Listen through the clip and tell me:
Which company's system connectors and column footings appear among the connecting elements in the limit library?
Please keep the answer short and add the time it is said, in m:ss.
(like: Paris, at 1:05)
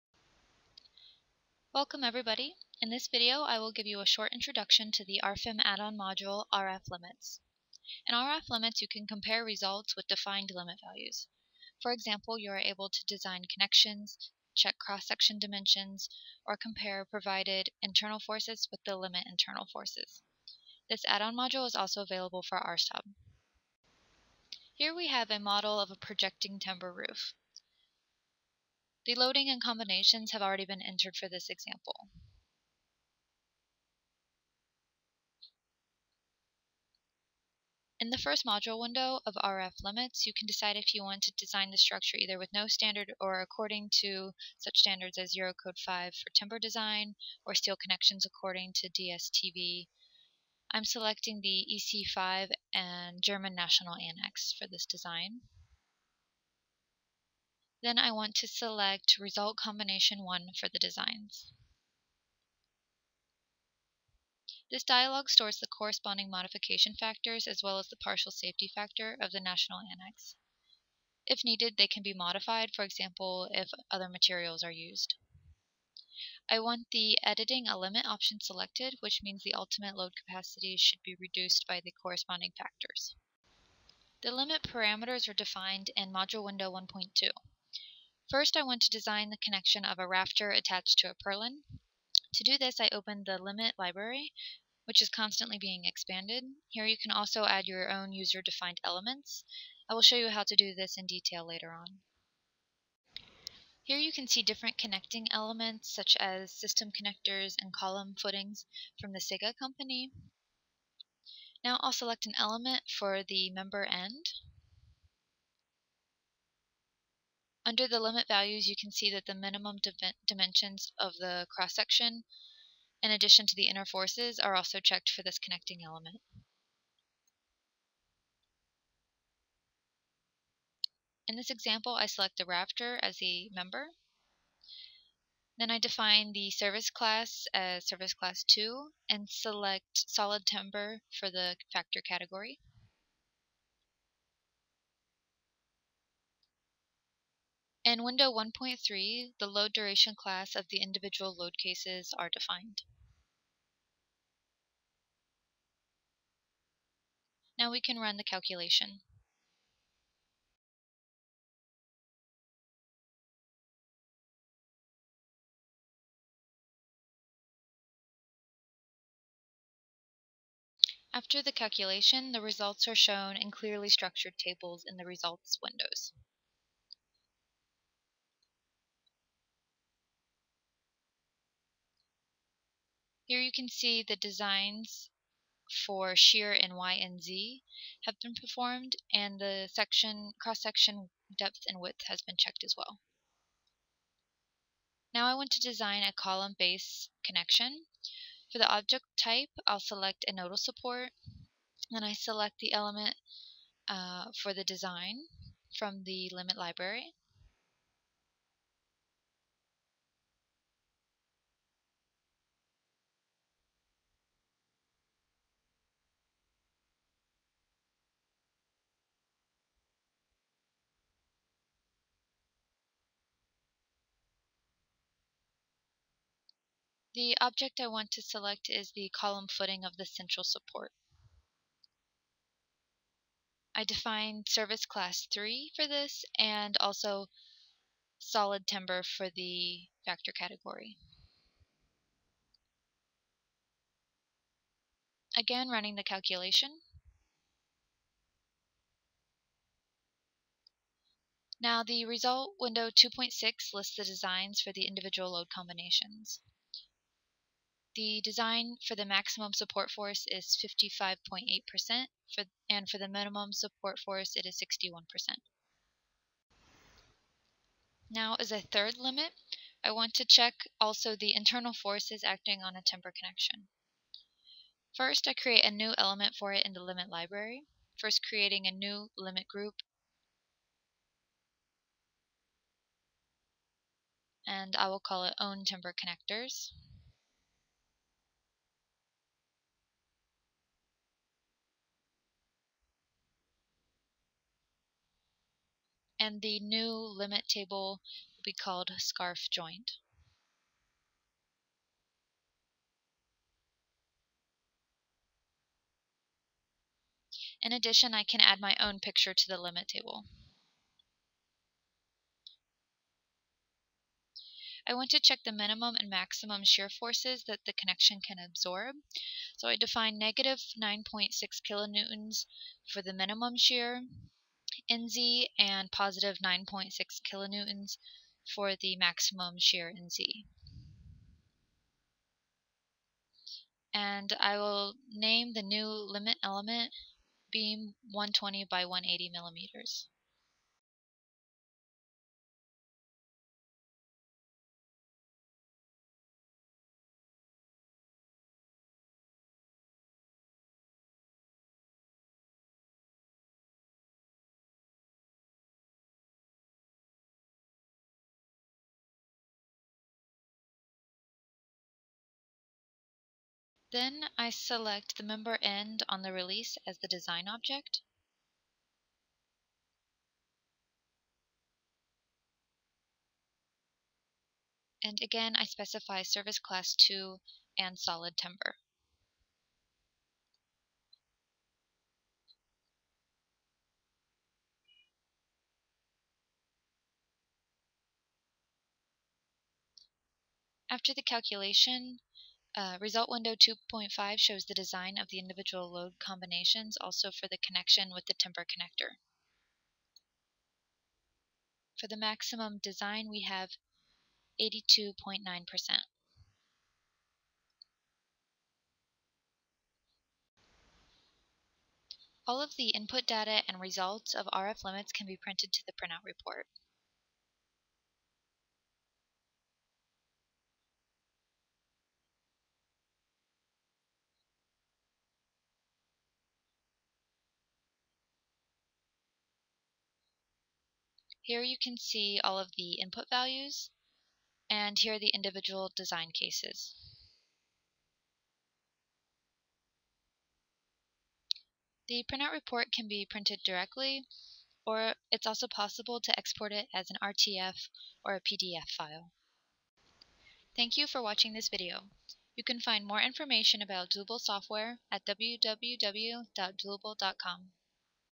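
SIHGA, at 1:49.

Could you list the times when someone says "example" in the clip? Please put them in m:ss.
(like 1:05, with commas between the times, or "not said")
0:11, 0:31, 1:12, 2:11.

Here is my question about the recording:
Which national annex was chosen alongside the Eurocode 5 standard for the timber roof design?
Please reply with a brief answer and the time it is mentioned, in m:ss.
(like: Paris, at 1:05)
German National Annex, at 0:53.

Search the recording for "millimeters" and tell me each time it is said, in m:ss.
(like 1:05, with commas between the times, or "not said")
5:39.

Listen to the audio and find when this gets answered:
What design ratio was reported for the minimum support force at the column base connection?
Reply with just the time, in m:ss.
4:24.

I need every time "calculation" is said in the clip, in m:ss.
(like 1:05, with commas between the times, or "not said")
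2:38, 2:51, 4:06, 6:31.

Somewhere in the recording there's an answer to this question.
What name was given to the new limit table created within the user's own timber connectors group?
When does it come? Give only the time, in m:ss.
4:58.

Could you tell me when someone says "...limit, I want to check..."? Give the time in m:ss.
4:28.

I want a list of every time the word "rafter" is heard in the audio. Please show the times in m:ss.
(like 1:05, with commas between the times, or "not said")
1:30, 2:12.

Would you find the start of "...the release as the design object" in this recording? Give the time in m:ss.
6:06.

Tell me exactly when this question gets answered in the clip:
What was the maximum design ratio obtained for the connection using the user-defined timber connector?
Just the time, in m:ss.
6:44.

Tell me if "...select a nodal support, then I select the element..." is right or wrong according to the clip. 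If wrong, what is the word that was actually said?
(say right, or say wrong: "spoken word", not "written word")
right.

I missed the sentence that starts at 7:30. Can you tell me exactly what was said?
Thank you for watching this video.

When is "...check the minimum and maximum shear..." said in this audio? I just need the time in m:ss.
5:15.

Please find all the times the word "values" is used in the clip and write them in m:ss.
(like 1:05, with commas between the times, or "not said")
0:10, 1:58, 7:13.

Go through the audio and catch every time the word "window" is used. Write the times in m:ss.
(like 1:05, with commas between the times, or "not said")
0:38, 1:26, 2:28, 2:55, 4:12, 6:33.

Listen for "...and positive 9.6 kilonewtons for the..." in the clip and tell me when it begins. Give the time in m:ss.
5:25.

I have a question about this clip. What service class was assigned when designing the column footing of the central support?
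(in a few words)
Service class 3.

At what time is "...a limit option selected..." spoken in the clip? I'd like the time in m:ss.
1:17.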